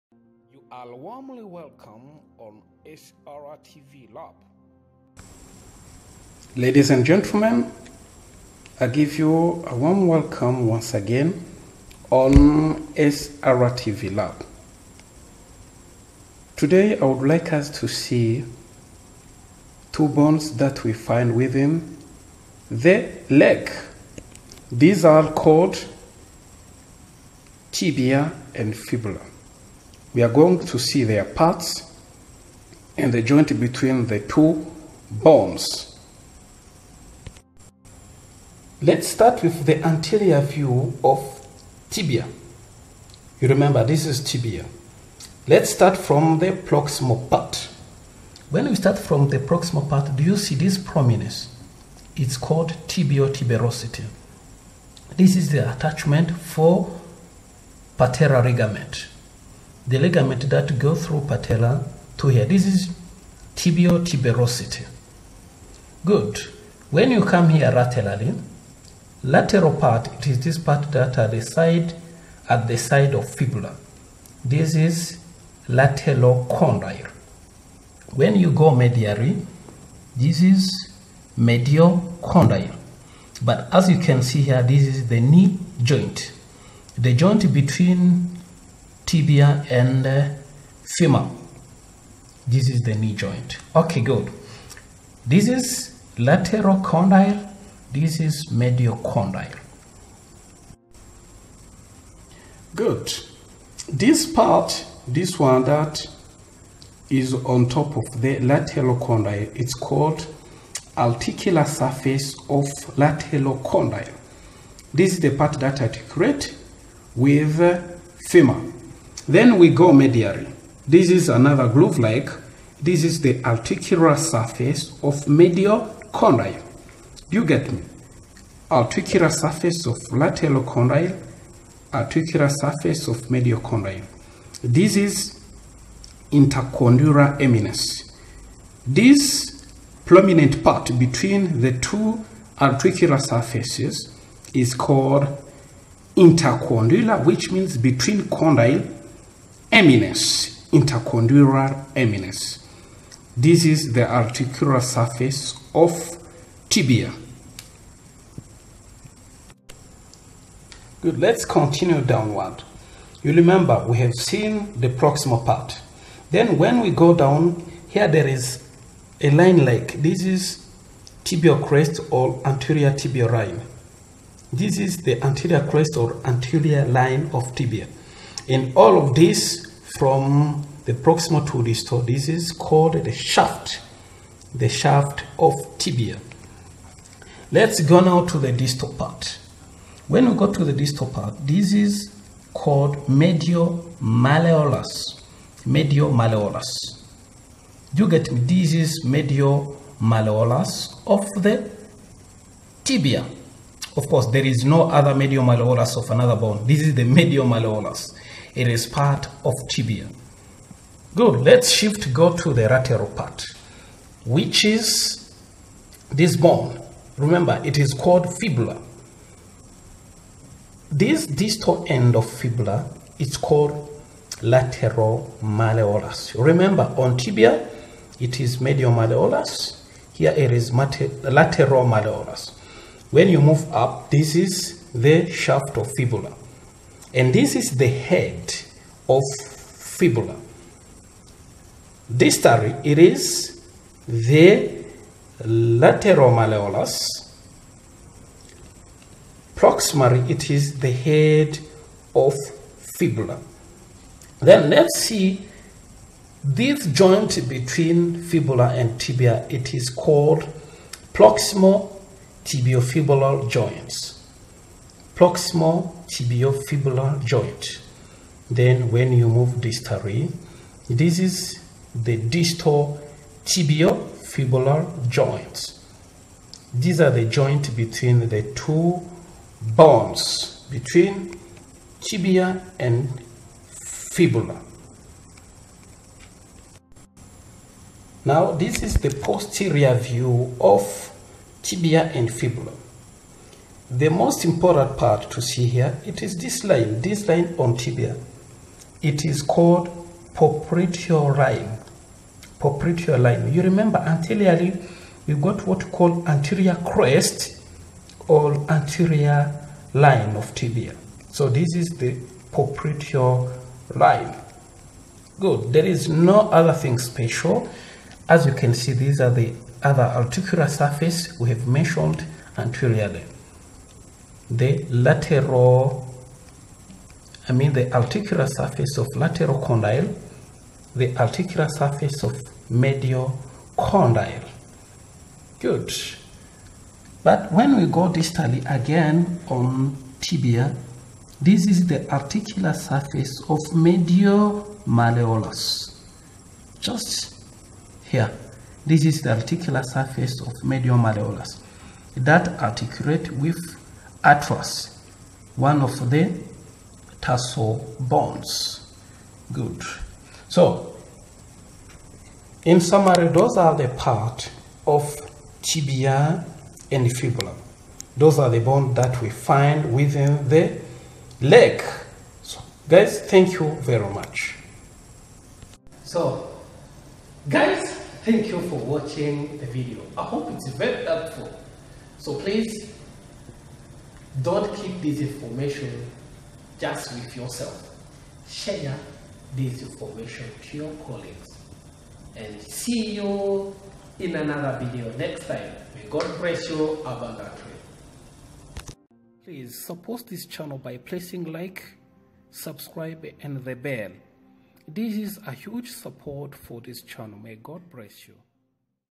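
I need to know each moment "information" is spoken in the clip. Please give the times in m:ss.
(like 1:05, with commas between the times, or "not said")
6:25, 6:29.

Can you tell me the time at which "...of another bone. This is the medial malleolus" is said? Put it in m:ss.
3:25.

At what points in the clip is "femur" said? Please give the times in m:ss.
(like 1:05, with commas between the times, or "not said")
1:30, 1:58.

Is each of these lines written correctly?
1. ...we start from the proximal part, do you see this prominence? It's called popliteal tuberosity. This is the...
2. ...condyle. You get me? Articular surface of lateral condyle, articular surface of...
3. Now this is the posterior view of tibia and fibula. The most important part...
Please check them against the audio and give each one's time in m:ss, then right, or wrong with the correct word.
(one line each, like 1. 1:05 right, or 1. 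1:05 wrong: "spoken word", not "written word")
1. 0:48 wrong: "tibial", not "popliteal"
2. 2:06 right
3. 4:48 right.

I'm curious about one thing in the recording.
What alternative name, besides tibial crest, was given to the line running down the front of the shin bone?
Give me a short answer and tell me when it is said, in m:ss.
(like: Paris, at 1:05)
Anterior tibial line, at 2:52.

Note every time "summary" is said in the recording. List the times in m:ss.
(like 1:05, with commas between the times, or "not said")
6:02.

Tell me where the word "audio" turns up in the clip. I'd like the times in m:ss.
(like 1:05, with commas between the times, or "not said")
not said.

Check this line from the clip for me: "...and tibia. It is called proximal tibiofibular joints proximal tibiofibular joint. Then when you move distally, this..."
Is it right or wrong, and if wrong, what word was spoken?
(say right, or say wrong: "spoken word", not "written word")
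right.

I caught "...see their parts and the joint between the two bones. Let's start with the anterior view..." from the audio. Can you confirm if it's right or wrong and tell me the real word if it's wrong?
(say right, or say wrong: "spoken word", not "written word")
right.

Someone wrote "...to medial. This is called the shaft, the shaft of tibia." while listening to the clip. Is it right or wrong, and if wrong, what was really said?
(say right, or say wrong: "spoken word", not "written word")
wrong: "distal", not "medial".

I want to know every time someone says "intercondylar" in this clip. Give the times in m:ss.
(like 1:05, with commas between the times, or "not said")
2:16, 2:26, 2:30.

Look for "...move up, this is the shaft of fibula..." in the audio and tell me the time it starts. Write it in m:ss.
3:53.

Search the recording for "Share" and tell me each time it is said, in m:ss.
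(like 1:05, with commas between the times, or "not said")
6:28.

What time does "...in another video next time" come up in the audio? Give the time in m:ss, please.
6:34.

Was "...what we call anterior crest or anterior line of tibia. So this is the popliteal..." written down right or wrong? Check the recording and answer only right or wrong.
right.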